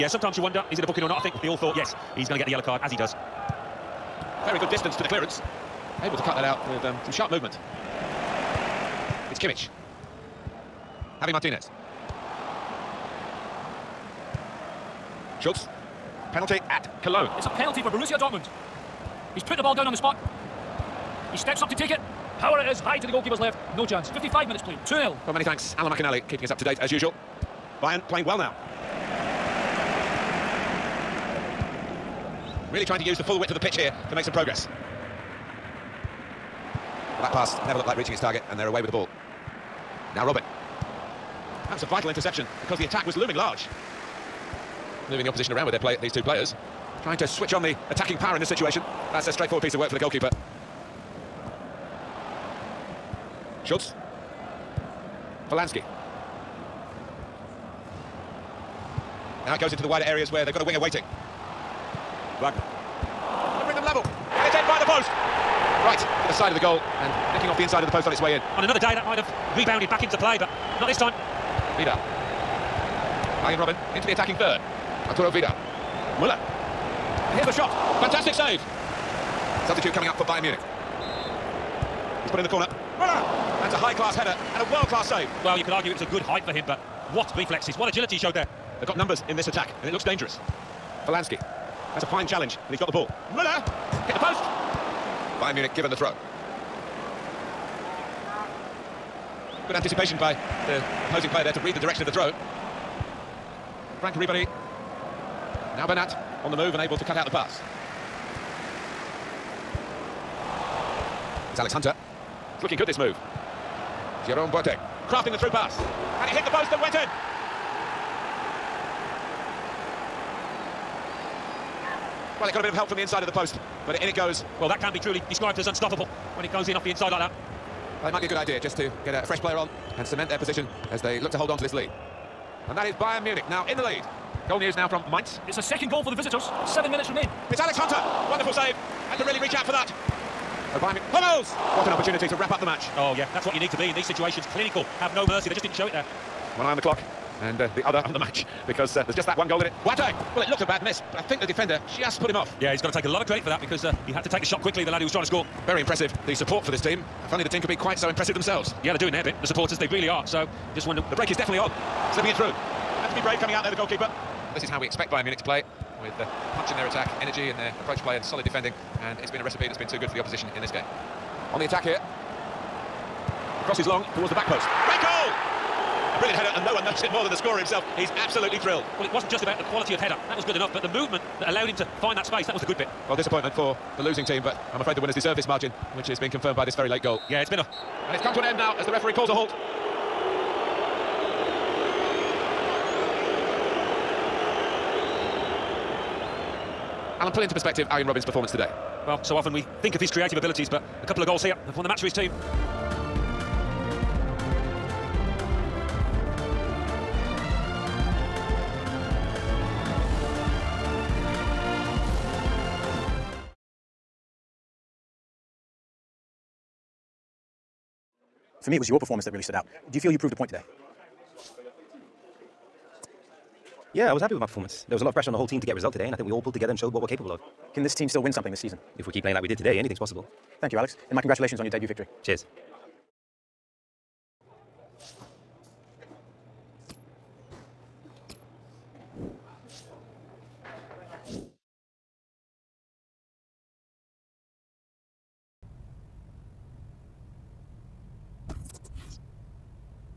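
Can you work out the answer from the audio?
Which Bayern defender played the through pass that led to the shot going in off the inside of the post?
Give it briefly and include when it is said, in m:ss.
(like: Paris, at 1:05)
Jerome Boateng, at 1:54.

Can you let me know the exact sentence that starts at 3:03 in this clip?
Well, disappointment for the losing team, but I'm afraid the winners deserve this margin.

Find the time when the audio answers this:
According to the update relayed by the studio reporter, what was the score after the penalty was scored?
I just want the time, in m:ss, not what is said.
0:24.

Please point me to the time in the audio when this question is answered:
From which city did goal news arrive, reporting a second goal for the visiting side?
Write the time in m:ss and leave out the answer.
2:15.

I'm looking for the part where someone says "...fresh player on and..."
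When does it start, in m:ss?
2:09.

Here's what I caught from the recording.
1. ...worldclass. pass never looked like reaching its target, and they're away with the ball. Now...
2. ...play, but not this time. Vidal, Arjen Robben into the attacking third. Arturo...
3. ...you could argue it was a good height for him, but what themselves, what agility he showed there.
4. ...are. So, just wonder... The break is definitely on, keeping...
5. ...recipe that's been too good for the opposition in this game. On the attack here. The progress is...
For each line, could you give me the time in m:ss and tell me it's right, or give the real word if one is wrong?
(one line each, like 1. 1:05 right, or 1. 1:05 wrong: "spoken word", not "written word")
1. 0:34 wrong: "progress", not "worldclass"
2. 1:10 right
3. 1:25 wrong: "reflexes", not "themselves"
4. 2:40 wrong: "slipping", not "keeping"
5. 2:49 wrong: "cross", not "progress".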